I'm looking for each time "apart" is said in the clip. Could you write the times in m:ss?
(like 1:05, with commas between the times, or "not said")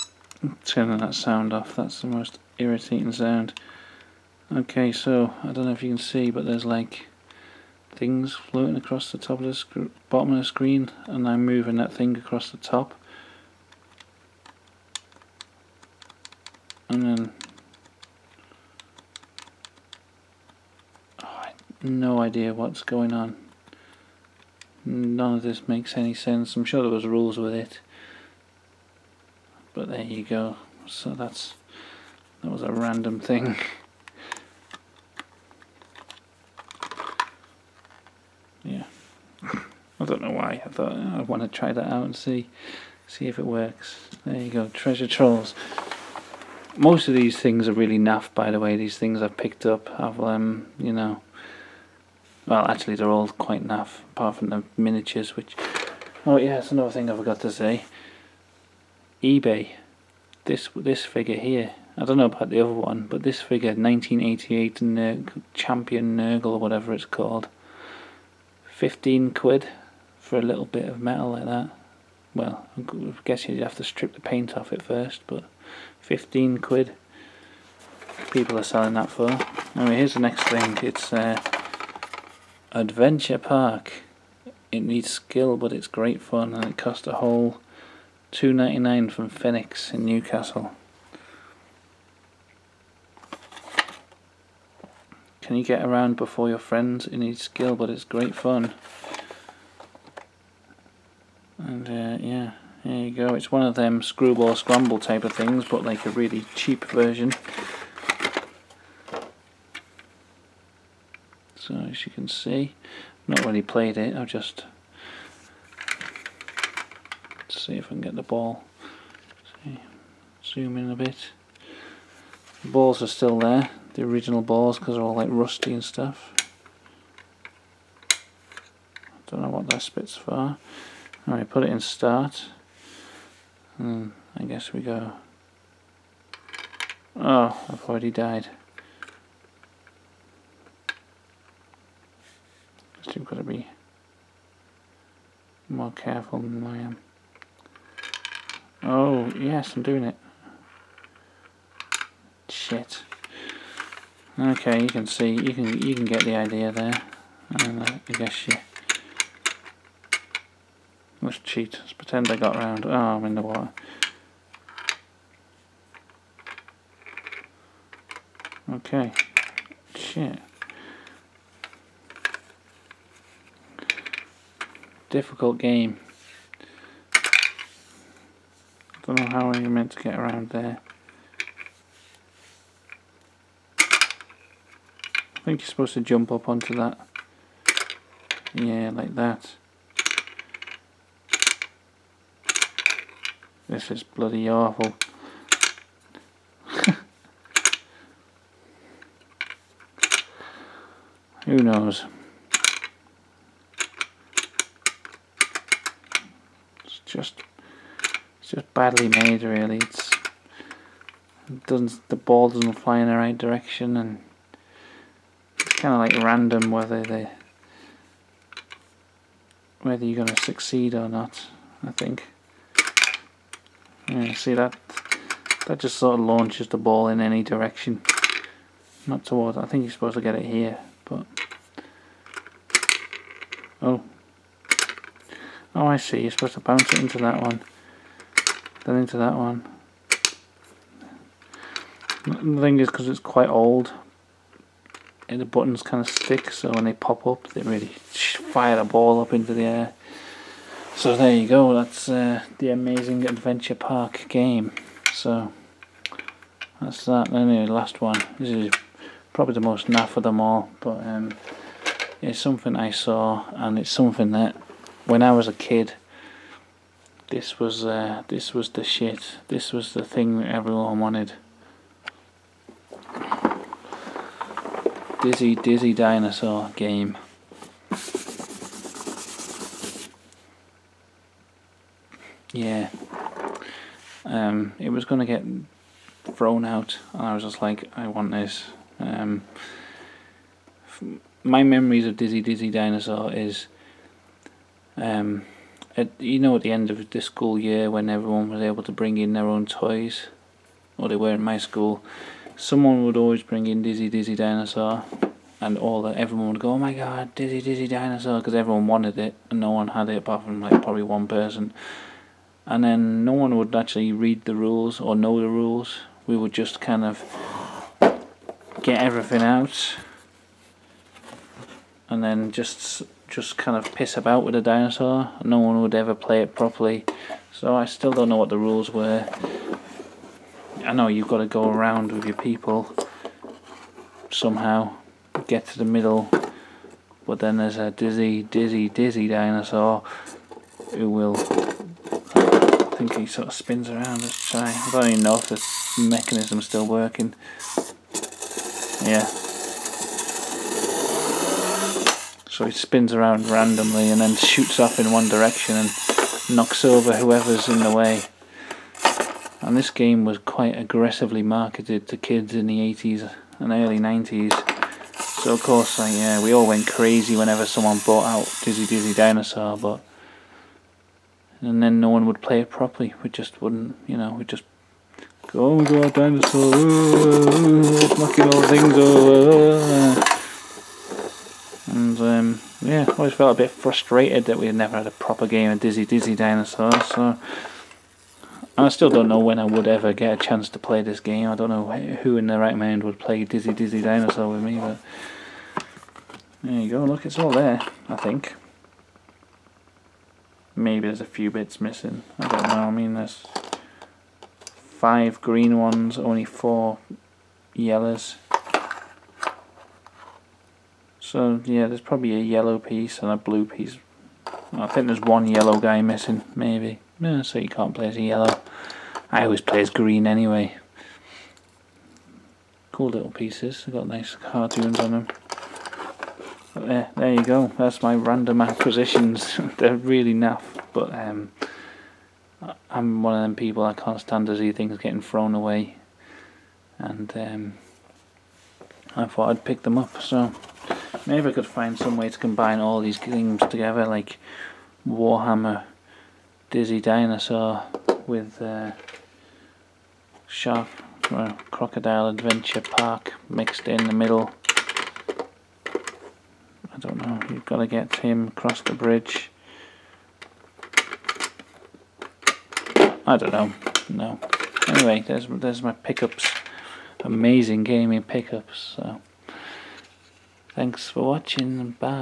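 0:54, 5:10.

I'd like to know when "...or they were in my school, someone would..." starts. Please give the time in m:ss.
5:00.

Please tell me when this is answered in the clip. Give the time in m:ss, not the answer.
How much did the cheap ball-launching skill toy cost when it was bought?
1:28.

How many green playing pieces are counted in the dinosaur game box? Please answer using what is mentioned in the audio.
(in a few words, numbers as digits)
5.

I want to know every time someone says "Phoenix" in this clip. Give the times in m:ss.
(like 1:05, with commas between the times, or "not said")
1:29.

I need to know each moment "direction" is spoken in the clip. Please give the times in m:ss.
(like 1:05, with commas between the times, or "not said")
3:33, 3:47, 5:55.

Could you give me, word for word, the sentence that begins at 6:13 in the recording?
We just wouldn't, you know, we just go, oh, go, a dinosaur, knocking all things over.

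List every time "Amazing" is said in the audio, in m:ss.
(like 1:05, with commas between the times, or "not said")
4:12, 7:47.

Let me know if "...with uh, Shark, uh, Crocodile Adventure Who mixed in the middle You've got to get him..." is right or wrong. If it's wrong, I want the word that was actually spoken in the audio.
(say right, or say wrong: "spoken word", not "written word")
wrong: "Park", not "Who".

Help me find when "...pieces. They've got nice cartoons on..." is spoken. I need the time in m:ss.
7:03.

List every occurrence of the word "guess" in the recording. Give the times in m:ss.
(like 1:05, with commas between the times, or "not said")
1:13, 2:14, 2:23, 2:38.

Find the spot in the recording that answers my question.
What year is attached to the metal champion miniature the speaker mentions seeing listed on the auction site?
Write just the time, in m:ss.
1:03.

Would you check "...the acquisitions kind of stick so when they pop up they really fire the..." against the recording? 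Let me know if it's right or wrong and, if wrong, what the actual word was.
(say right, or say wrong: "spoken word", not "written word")
wrong: "buttons", not "acquisitions".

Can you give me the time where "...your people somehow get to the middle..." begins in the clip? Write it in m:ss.
5:32.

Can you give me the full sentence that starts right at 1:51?
So as you can see, not really played it.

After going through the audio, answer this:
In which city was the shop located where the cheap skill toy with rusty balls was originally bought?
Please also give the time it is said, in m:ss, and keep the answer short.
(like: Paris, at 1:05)
Newcastle, at 1:30.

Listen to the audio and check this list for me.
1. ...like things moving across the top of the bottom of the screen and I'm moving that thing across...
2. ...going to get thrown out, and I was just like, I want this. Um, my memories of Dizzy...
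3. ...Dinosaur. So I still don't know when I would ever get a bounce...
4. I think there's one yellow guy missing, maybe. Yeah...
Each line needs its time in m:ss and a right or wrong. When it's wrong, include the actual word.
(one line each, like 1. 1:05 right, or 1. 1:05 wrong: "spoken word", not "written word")
1. 0:06 wrong: "floating", not "moving"
2. 4:45 right
3. 6:26 wrong: "chance", not "bounce"
4. 6:54 right.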